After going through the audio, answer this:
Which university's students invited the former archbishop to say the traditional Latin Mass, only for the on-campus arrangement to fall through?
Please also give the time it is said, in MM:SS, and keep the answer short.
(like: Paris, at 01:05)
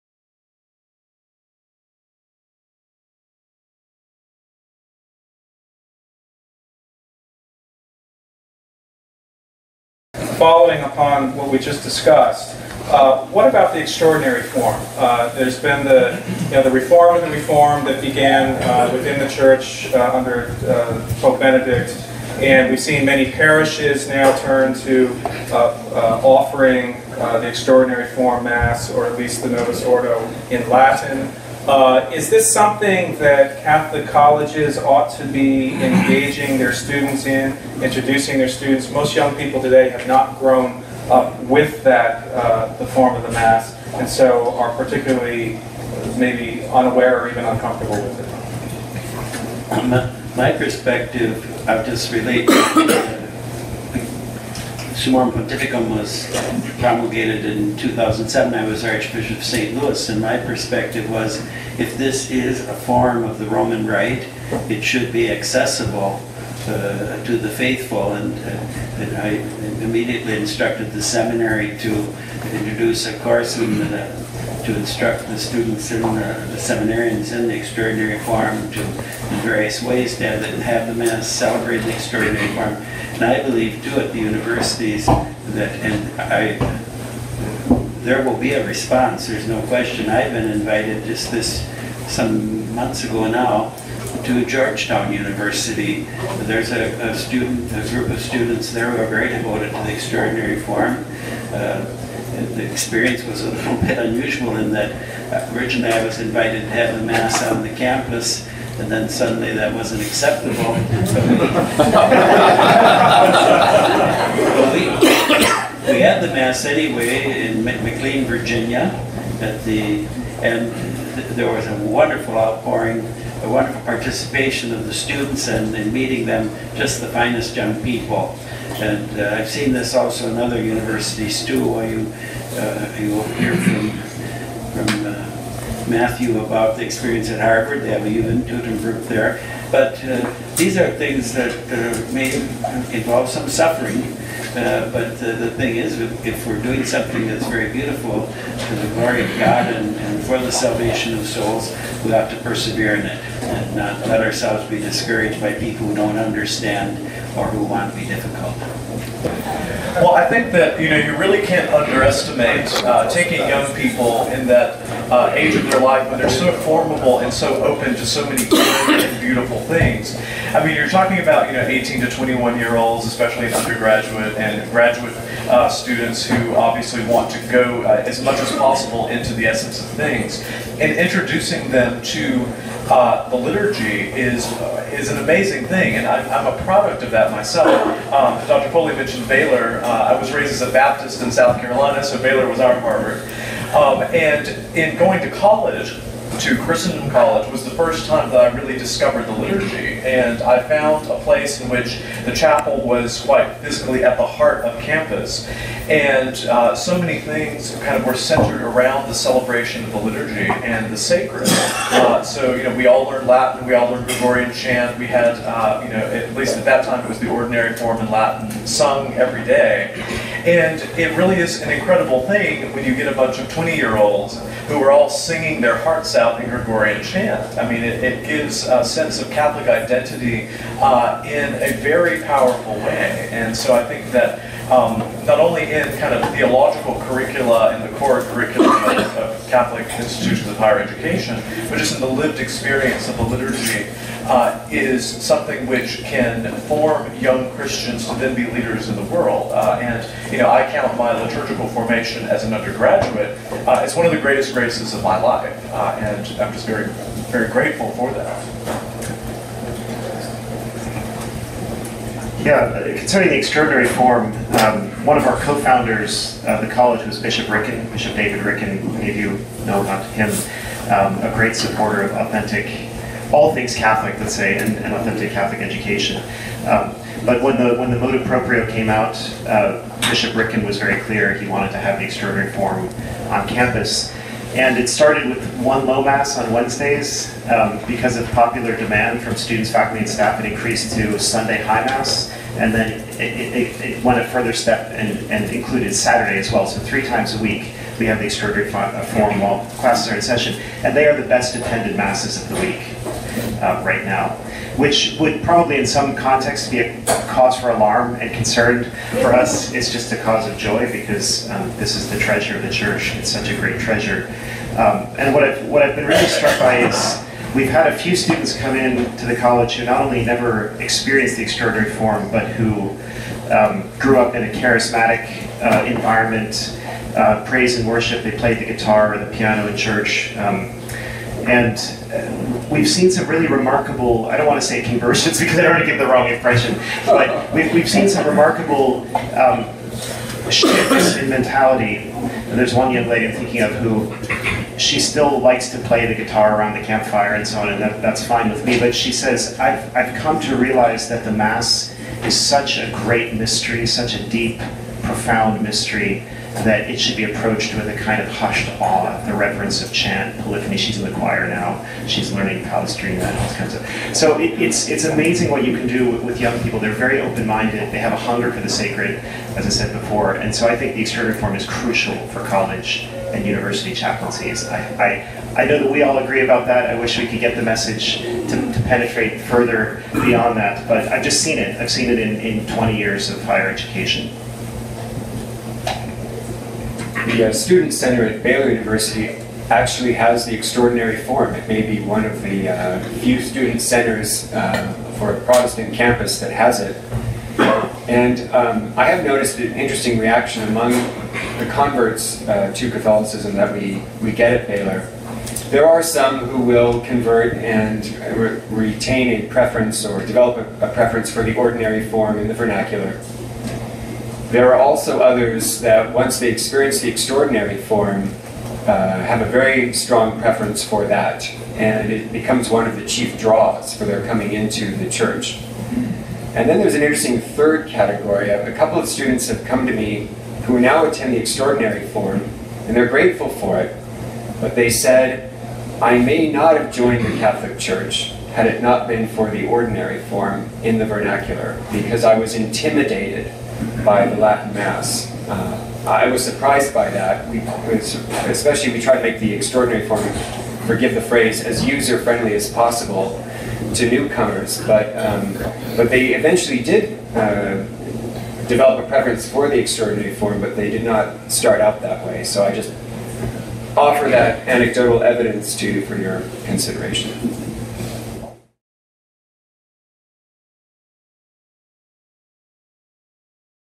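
Georgetown University, at 01:34.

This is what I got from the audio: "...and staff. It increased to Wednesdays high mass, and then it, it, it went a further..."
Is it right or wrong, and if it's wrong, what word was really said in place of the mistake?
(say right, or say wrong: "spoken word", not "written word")
wrong: "Sunday", not "Wednesdays".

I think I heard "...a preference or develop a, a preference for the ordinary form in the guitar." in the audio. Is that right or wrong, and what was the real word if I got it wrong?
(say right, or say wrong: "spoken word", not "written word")
wrong: "vernacular", not "guitar".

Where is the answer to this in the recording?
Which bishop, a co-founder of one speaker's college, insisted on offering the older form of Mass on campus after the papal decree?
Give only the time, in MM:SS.
04:27.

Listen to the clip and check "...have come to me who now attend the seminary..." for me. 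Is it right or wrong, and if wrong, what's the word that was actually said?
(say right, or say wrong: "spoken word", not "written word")
wrong: "extraordinary", not "seminary".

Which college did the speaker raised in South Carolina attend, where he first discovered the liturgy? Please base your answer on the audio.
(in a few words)
Christendom College.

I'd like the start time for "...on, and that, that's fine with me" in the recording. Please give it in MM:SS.
05:47.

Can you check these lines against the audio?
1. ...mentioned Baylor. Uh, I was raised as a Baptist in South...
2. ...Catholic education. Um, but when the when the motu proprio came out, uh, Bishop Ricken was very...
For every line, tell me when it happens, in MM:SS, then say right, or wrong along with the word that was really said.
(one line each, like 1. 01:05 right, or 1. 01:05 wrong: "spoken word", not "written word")
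1. 03:08 right
2. 04:35 right.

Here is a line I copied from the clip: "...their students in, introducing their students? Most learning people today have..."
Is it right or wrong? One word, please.
wrong.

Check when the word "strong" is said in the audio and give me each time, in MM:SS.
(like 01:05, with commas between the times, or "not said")
06:59.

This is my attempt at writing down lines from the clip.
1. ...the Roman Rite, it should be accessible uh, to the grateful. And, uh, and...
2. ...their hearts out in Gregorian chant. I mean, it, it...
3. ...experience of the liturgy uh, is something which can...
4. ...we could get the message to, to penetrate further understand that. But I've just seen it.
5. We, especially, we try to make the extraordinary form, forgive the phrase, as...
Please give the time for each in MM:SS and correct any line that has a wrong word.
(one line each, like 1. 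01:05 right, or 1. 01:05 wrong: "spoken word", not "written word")
1. 01:03 wrong: "faithful", not "grateful"
2. 03:45 right
3. 04:02 right
4. 06:17 wrong: "beyond", not "understand"
5. 07:27 right.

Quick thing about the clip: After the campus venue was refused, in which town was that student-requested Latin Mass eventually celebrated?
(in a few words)
McLean, Virginia.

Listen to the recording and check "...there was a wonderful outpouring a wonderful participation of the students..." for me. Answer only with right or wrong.
right.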